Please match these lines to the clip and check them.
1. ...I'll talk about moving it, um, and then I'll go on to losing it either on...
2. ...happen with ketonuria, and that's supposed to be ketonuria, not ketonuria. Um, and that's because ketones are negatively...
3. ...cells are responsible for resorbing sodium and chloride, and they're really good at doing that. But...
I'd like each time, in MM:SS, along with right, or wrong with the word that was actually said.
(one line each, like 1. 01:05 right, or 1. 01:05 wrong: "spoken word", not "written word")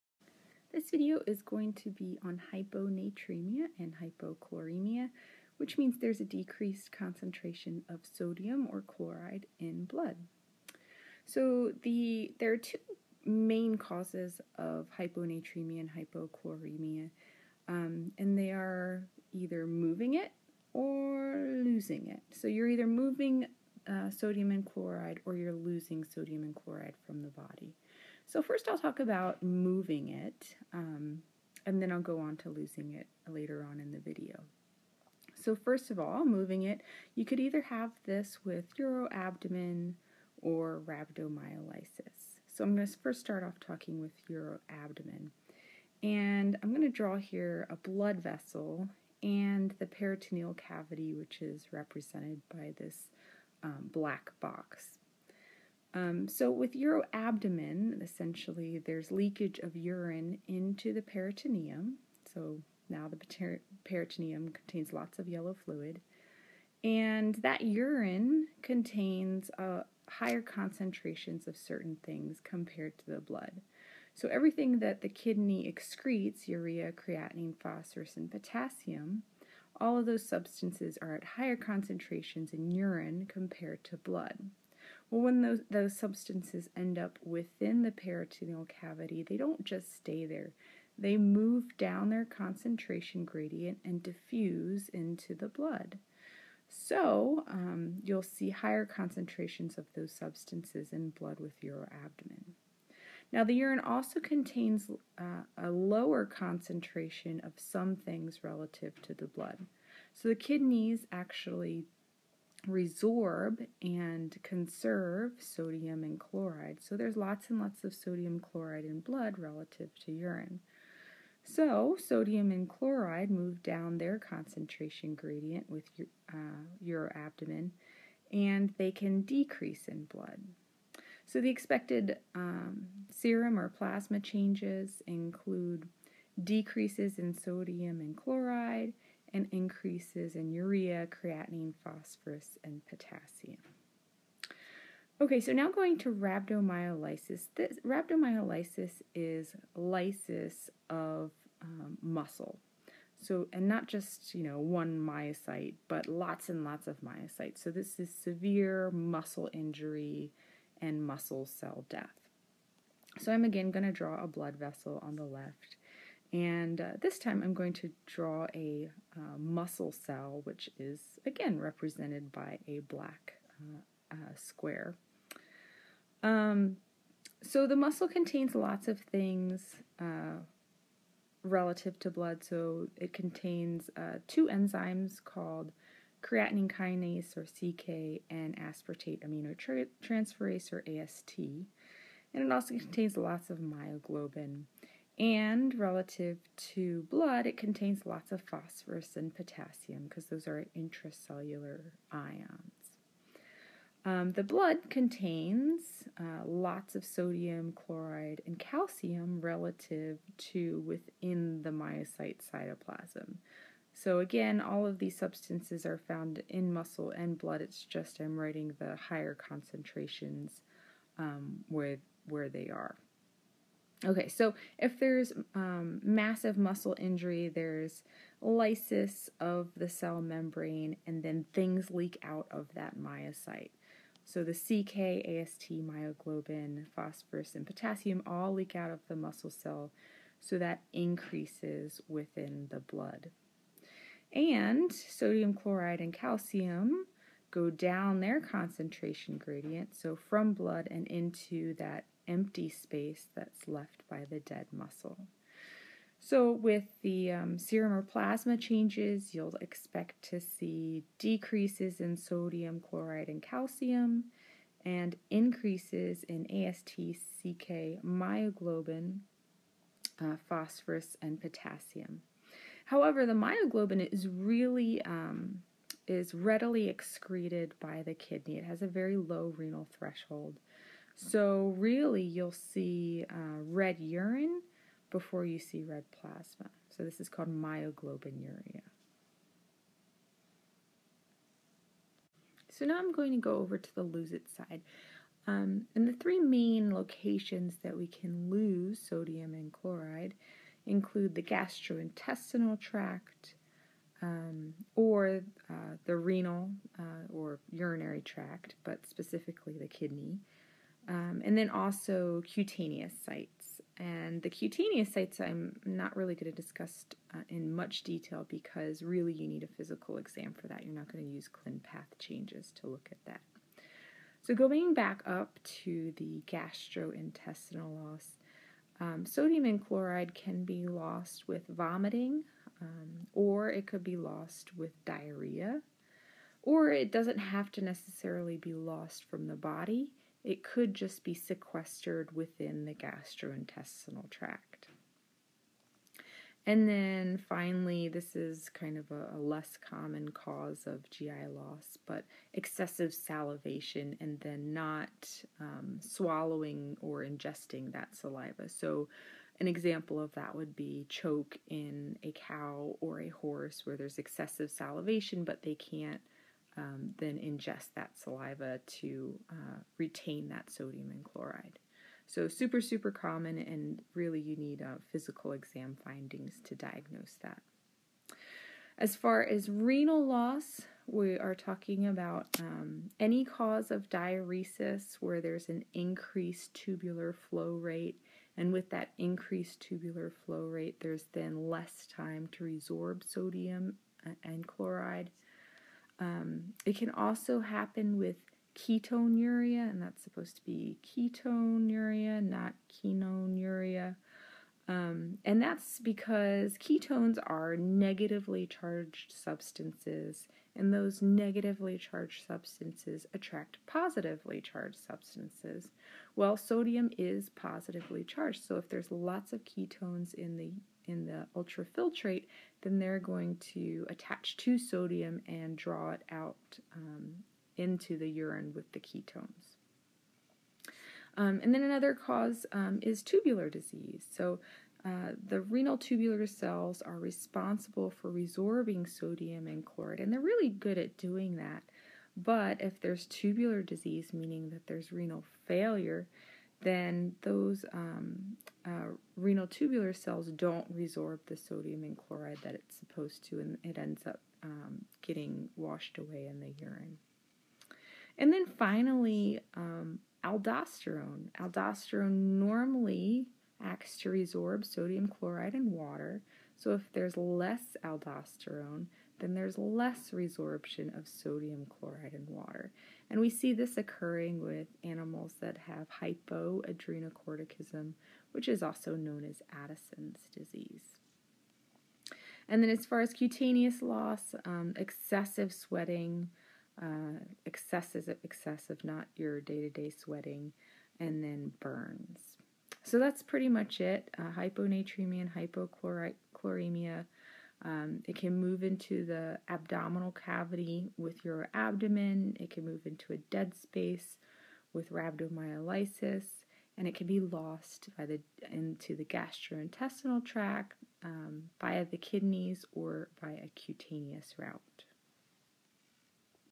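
1. 00:28 wrong: "later", not "either"
2. 06:37 right
3. 07:16 right.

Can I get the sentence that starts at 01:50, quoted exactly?
So the kidneys actually resorb and conserve sodium and chloride.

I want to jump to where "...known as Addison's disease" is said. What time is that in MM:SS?
07:59.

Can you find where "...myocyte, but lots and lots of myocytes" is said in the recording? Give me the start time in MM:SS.
02:34.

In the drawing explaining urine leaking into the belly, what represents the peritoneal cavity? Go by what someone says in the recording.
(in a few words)
black box.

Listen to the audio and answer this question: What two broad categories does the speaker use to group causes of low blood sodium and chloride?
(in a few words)
moving it or losing it.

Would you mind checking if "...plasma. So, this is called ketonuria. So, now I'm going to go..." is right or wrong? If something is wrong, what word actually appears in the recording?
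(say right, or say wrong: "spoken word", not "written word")
wrong: "myoglobinuria", not "ketonuria".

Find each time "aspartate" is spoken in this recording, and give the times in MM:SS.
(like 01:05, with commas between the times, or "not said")
03:08.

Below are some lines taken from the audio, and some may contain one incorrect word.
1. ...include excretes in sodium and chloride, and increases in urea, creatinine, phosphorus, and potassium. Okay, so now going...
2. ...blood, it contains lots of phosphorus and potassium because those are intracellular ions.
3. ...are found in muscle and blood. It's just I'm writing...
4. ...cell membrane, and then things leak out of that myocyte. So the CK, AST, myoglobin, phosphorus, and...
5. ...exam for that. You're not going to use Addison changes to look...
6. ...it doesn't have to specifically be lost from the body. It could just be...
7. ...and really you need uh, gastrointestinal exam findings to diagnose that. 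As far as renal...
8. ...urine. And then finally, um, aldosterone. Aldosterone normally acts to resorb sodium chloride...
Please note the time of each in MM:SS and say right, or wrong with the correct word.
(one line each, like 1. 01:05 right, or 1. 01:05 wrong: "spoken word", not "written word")
1. 02:15 wrong: "decreases", not "excretes"
2. 03:17 right
3. 03:35 right
4. 03:49 right
5. 05:20 wrong: "ClinPath", not "Addison"
6. 05:36 wrong: "necessarily", not "specifically"
7. 06:13 wrong: "physical", not "gastrointestinal"
8. 07:36 right.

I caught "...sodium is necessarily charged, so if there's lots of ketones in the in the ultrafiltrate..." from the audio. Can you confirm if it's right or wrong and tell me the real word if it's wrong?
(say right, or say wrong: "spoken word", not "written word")
wrong: "positively", not "necessarily".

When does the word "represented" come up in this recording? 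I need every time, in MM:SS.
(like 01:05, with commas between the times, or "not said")
00:51, 02:51.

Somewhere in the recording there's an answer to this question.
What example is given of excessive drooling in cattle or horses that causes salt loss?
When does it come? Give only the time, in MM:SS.
06:01.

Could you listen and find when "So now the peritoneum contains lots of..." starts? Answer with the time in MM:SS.
01:02.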